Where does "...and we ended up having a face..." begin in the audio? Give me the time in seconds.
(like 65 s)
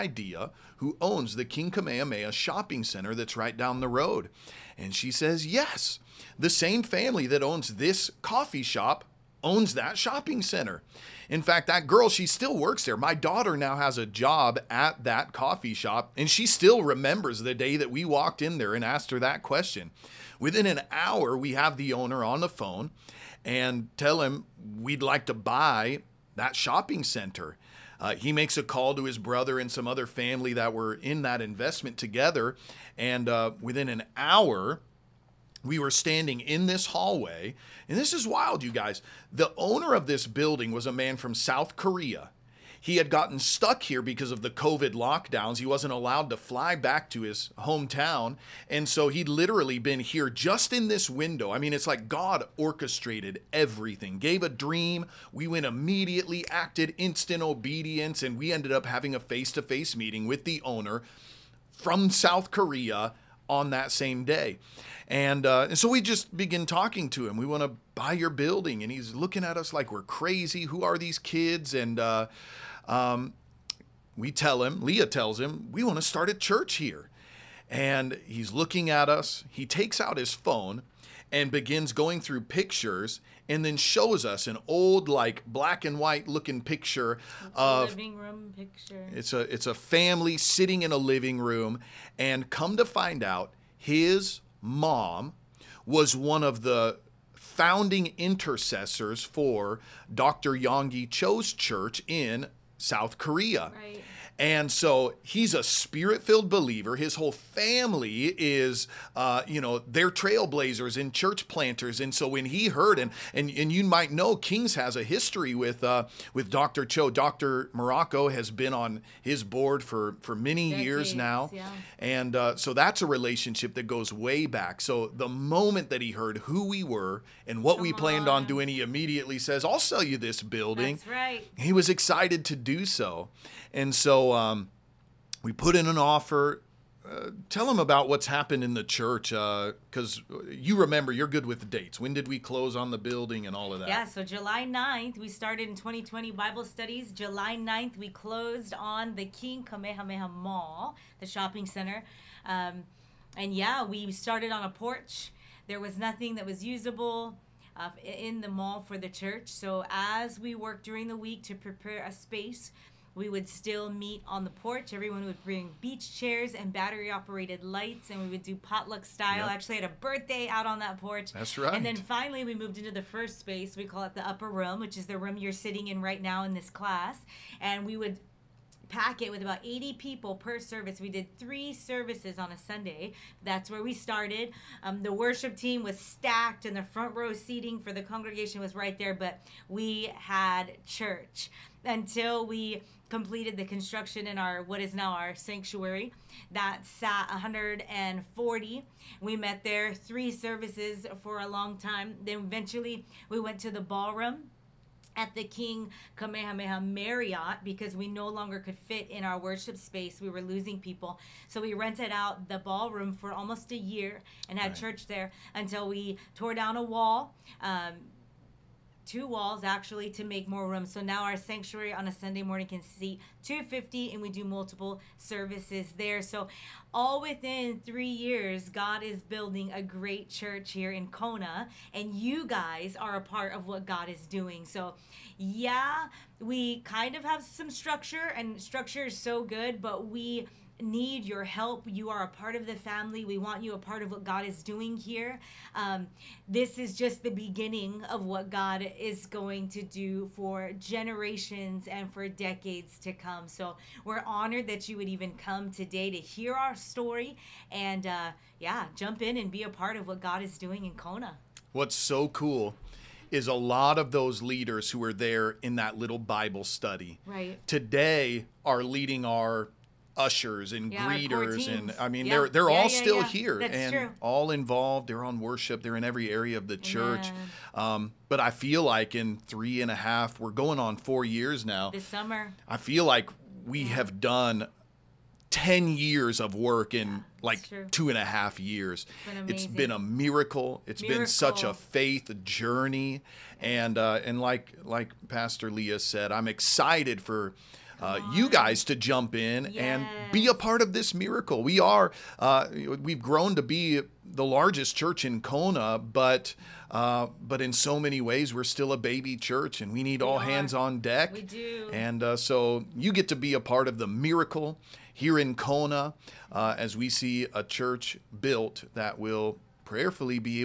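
58 s.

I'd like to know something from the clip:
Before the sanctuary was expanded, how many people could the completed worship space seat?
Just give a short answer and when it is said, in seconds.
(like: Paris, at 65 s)
140, at 197 s.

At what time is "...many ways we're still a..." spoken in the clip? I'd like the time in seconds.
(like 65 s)
308 s.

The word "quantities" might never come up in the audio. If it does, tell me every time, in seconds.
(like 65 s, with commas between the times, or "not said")
not said.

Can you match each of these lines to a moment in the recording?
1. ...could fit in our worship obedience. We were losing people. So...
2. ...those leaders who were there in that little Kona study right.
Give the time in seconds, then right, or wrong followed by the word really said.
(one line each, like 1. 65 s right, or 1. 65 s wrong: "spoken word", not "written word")
1. 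208 s wrong: "space", not "obedience"
2. 264 s wrong: "Bible", not "Kona".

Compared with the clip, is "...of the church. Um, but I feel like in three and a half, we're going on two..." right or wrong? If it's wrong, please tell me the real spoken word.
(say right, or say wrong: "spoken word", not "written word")
wrong: "four", not "two".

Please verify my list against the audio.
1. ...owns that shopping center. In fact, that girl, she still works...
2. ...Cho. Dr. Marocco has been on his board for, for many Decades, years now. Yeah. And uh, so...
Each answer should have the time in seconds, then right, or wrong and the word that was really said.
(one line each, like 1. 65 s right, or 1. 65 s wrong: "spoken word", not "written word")
1. 9 s right
2. 116 s right.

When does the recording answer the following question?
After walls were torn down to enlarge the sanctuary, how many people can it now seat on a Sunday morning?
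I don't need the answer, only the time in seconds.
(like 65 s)
223 s.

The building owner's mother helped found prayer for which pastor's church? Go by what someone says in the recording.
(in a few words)
Dr. Yonggi Cho.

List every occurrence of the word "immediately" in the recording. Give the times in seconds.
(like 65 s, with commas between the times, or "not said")
55 s, 128 s.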